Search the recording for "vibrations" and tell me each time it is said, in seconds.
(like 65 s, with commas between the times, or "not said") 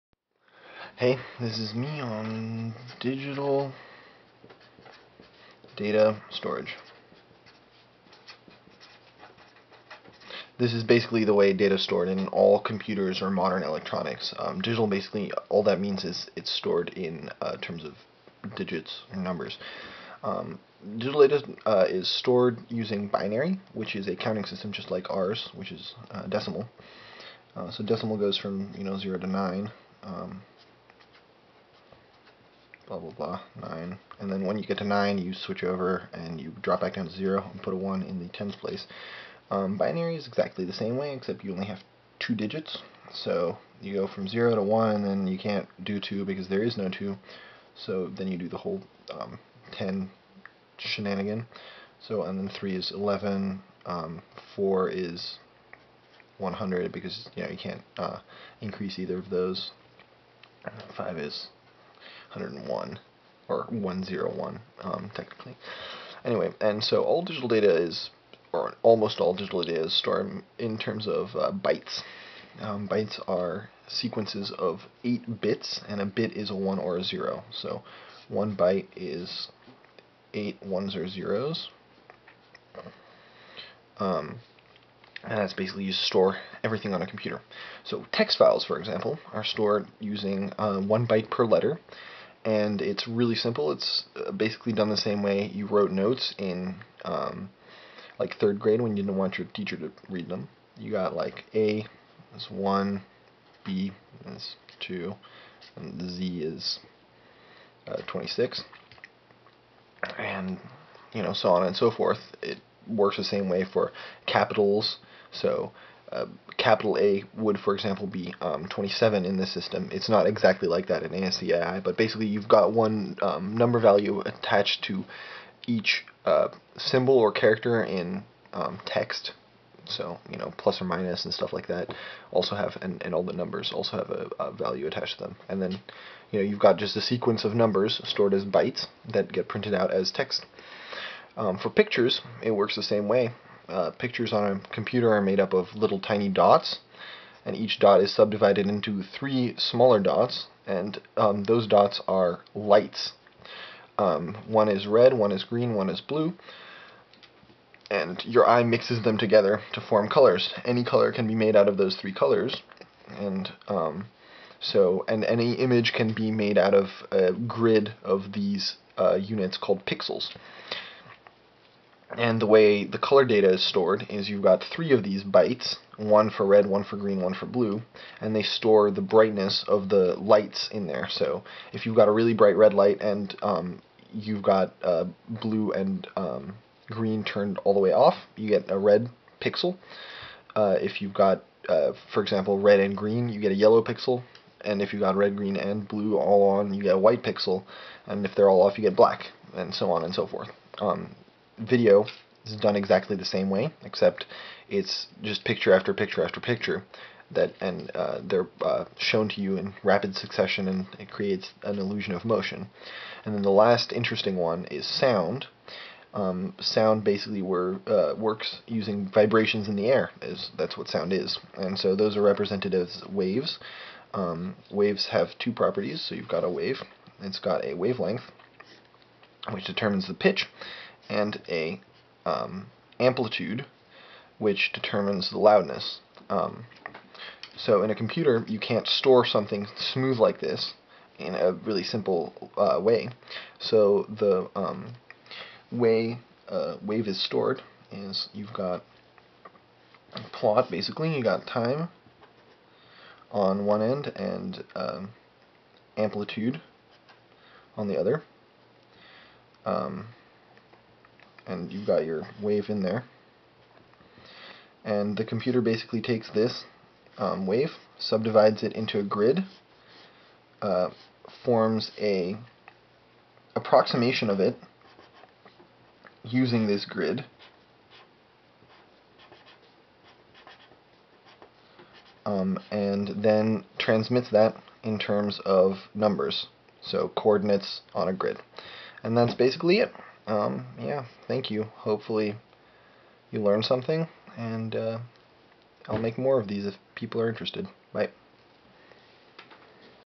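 219 s.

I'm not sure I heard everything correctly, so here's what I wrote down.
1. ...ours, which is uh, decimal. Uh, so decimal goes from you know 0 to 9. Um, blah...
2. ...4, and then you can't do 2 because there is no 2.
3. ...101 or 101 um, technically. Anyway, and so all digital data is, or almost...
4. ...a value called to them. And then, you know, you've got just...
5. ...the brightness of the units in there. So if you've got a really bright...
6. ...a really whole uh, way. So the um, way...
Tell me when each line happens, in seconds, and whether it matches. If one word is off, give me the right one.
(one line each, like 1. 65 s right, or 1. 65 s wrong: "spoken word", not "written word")
1. 25 s right
2. 44 s wrong: "1", not "4"
3. 62 s right
4. 134 s wrong: "attached", not "called"
5. 178 s wrong: "lights", not "units"
6. 241 s wrong: "simple", not "whole".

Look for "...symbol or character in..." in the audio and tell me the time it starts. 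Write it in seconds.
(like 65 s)
126 s.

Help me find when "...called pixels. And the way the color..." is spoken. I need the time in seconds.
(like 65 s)
169 s.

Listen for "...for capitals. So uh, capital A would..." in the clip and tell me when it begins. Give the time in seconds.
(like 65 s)
113 s.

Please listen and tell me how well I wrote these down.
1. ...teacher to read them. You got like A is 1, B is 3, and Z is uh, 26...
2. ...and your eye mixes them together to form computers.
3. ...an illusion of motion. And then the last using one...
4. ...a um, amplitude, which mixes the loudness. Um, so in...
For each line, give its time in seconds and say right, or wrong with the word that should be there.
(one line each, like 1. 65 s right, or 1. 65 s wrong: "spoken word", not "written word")
1. 99 s wrong: "2", not "3"
2. 157 s wrong: "colors", not "computers"
3. 211 s wrong: "interesting", not "using"
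4. 231 s wrong: "determines", not "mixes".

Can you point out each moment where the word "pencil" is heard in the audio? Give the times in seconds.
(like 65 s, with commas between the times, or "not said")
not said.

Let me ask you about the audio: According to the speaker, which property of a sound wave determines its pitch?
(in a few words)
wavelength.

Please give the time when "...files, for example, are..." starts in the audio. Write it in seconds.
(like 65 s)
88 s.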